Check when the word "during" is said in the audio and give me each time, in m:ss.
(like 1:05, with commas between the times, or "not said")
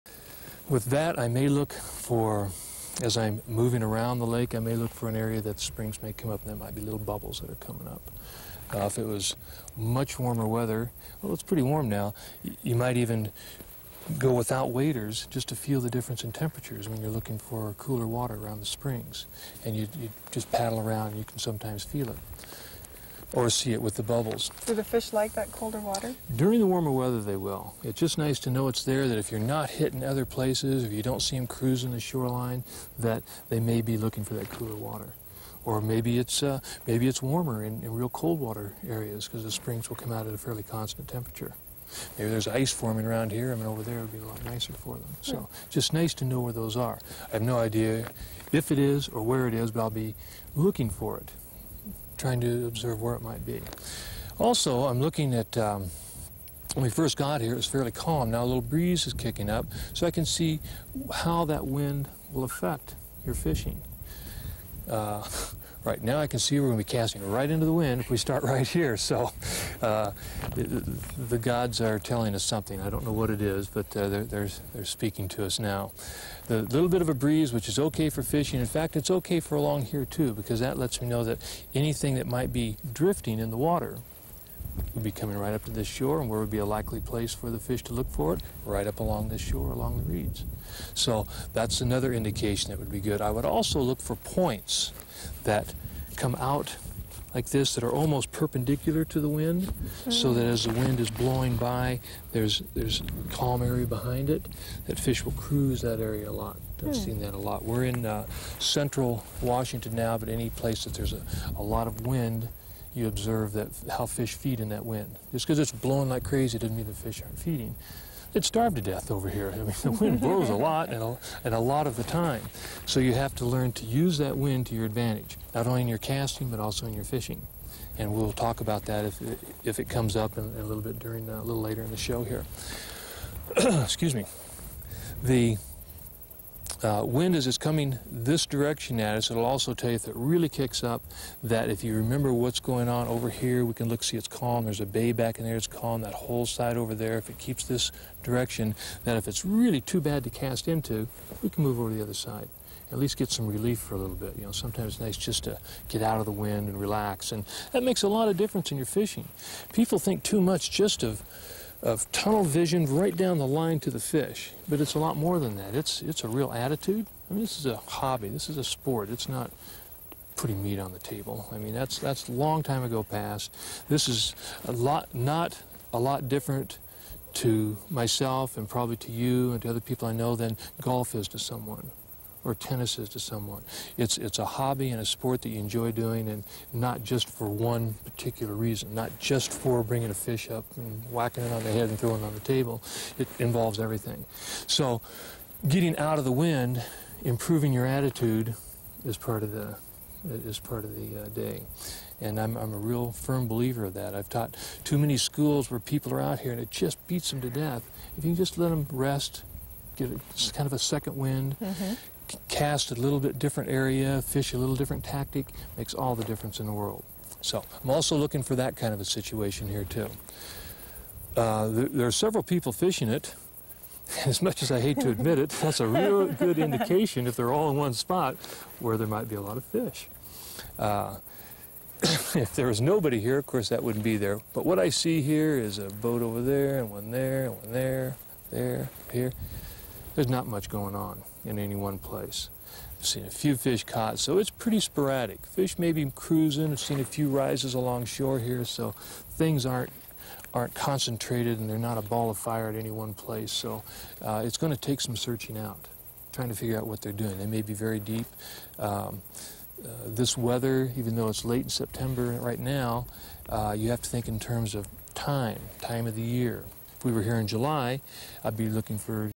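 0:26, 2:10.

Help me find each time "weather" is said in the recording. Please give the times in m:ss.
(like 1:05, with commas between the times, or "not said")
0:10, 0:26, 4:20.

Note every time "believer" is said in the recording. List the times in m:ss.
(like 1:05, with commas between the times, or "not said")
3:23.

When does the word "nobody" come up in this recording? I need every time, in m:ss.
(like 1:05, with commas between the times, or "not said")
3:52.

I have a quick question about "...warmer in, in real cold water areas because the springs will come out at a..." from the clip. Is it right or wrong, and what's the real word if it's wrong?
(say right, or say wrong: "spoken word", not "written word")
right.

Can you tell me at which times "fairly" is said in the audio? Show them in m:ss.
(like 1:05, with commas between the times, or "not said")
0:40, 0:57.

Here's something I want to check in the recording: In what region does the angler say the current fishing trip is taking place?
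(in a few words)
central Washington.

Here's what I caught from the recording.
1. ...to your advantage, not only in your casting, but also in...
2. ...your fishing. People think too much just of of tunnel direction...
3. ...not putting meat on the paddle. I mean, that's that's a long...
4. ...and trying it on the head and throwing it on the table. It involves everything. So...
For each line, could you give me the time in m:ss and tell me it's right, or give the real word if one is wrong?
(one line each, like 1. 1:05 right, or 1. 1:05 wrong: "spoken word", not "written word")
1. 2:04 right
2. 2:38 wrong: "vision", not "direction"
3. 2:49 wrong: "table", not "paddle"
4. 3:10 wrong: "whacking", not "trying".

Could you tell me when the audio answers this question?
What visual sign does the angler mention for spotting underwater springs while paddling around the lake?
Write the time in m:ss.
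0:06.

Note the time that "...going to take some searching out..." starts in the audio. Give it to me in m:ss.
4:14.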